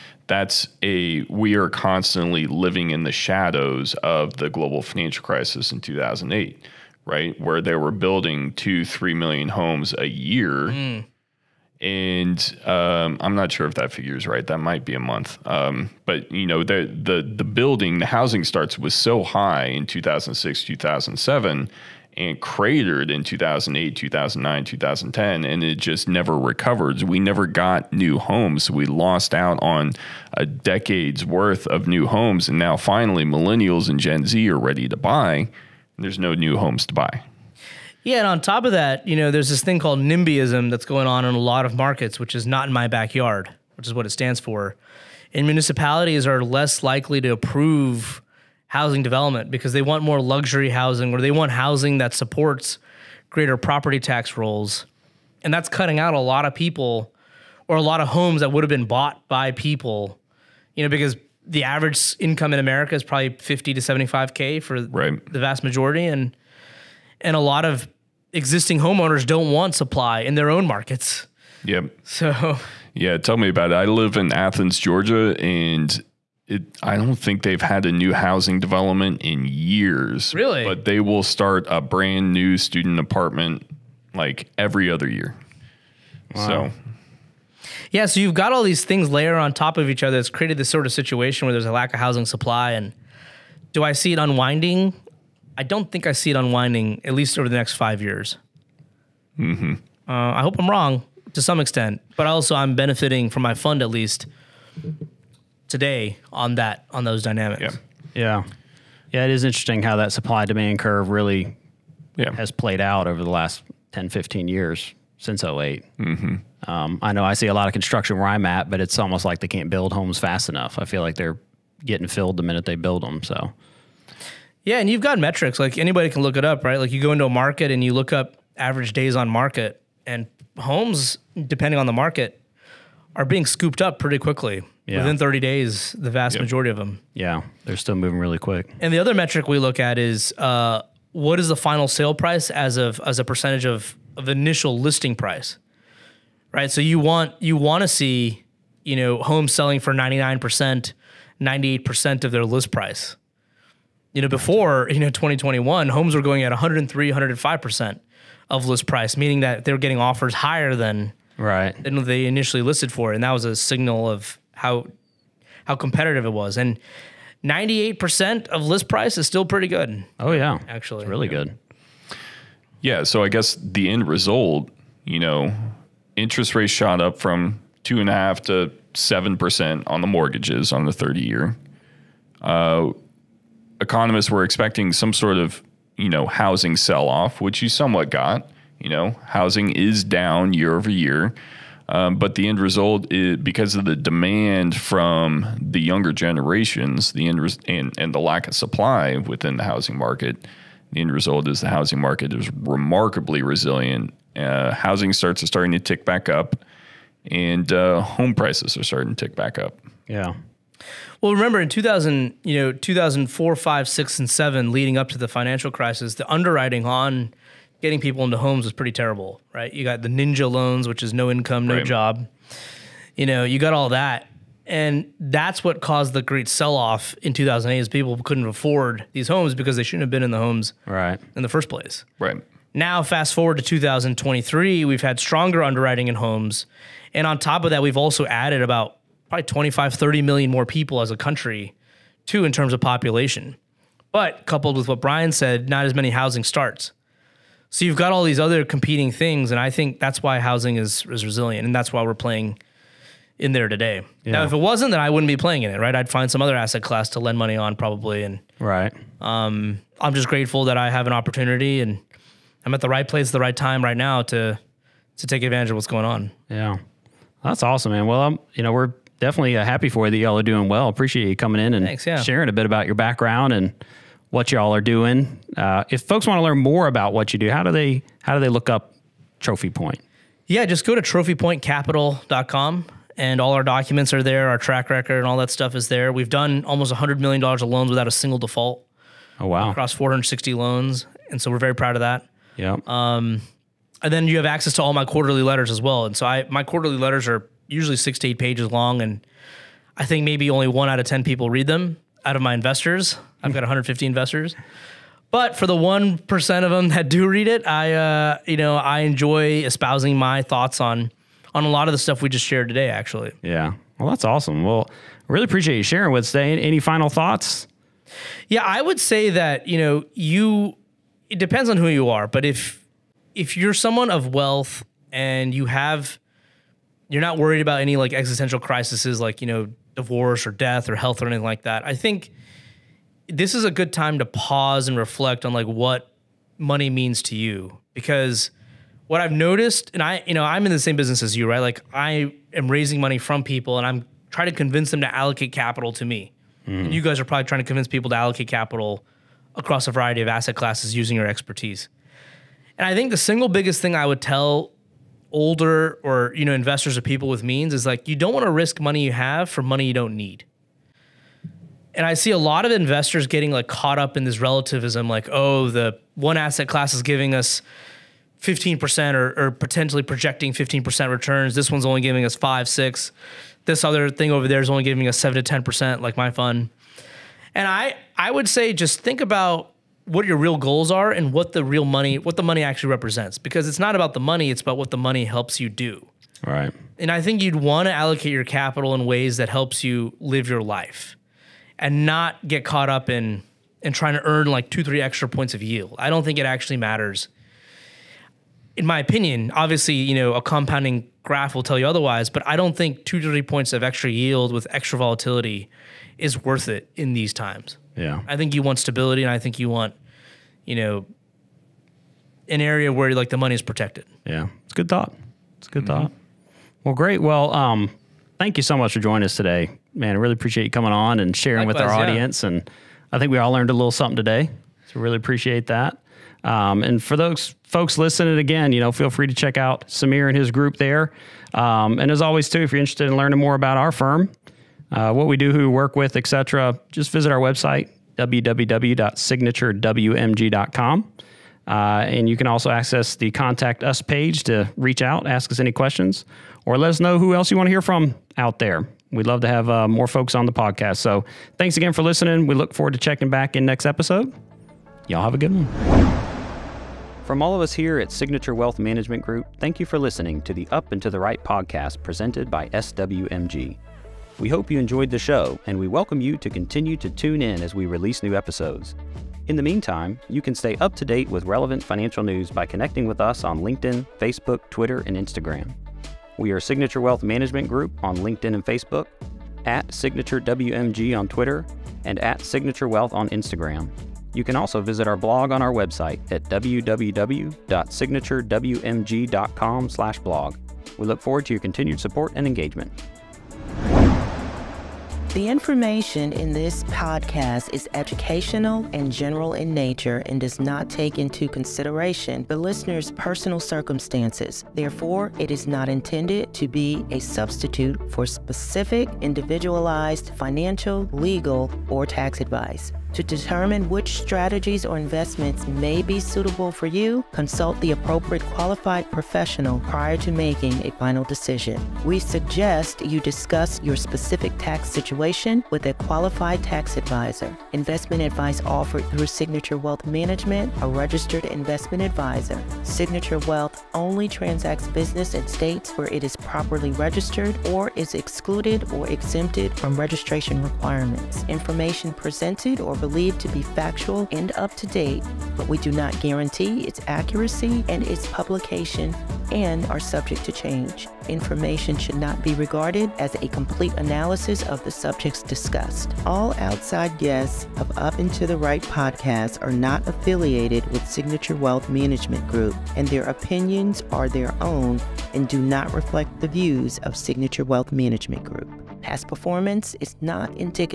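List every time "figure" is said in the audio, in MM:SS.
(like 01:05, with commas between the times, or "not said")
00:13.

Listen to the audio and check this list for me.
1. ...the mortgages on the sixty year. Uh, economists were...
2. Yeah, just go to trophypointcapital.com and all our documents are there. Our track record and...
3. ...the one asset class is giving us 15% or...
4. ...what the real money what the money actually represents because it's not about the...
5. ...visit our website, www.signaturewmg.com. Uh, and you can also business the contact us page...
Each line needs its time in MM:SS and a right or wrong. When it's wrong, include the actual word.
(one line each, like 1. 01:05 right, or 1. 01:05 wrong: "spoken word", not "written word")
1. 02:59 wrong: "thirty", not "sixty"
2. 04:40 right
3. 06:05 right
4. 06:21 right
5. 07:17 wrong: "access", not "business".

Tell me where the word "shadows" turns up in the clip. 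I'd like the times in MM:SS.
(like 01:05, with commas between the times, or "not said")
00:03.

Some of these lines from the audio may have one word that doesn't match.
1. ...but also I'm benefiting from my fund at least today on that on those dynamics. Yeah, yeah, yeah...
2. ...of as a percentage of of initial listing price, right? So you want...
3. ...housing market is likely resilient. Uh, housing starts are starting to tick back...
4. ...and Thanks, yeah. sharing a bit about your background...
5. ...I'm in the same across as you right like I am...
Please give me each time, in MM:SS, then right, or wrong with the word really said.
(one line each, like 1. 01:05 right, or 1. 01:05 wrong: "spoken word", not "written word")
1. 01:42 right
2. 02:22 right
3. 03:21 wrong: "remarkably", not "likely"
4. 04:31 right
5. 05:40 wrong: "business", not "across".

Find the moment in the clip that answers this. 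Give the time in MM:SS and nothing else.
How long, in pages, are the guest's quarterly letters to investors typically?
04:57.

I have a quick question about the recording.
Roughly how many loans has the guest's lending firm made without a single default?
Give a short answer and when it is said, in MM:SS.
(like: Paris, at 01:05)
460, at 04:49.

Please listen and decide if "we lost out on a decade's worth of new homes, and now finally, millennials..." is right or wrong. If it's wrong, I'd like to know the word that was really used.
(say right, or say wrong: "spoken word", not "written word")
right.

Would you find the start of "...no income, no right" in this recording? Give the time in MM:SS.
03:41.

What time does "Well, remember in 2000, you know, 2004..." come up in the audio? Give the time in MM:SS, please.
03:31.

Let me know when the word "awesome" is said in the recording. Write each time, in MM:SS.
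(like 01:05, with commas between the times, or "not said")
04:27, 05:14.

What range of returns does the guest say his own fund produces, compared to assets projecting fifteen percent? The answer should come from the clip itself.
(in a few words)
7 to 10%.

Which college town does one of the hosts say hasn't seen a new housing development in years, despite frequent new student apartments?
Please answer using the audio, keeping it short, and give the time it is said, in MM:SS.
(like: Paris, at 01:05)
Athens, Georgia, at 01:14.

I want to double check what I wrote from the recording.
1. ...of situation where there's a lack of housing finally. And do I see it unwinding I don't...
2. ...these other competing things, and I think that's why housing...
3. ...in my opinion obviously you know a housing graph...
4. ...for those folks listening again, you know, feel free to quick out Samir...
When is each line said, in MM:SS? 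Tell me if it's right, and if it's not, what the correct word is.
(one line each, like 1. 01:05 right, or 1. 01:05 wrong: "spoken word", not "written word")
1. 01:30 wrong: "supply", not "finally"
2. 04:08 right
3. 06:38 wrong: "compounding", not "housing"
4. 07:07 wrong: "check", not "quick".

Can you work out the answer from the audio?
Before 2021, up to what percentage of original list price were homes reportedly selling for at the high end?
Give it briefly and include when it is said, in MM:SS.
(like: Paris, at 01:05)
105%, at 02:37.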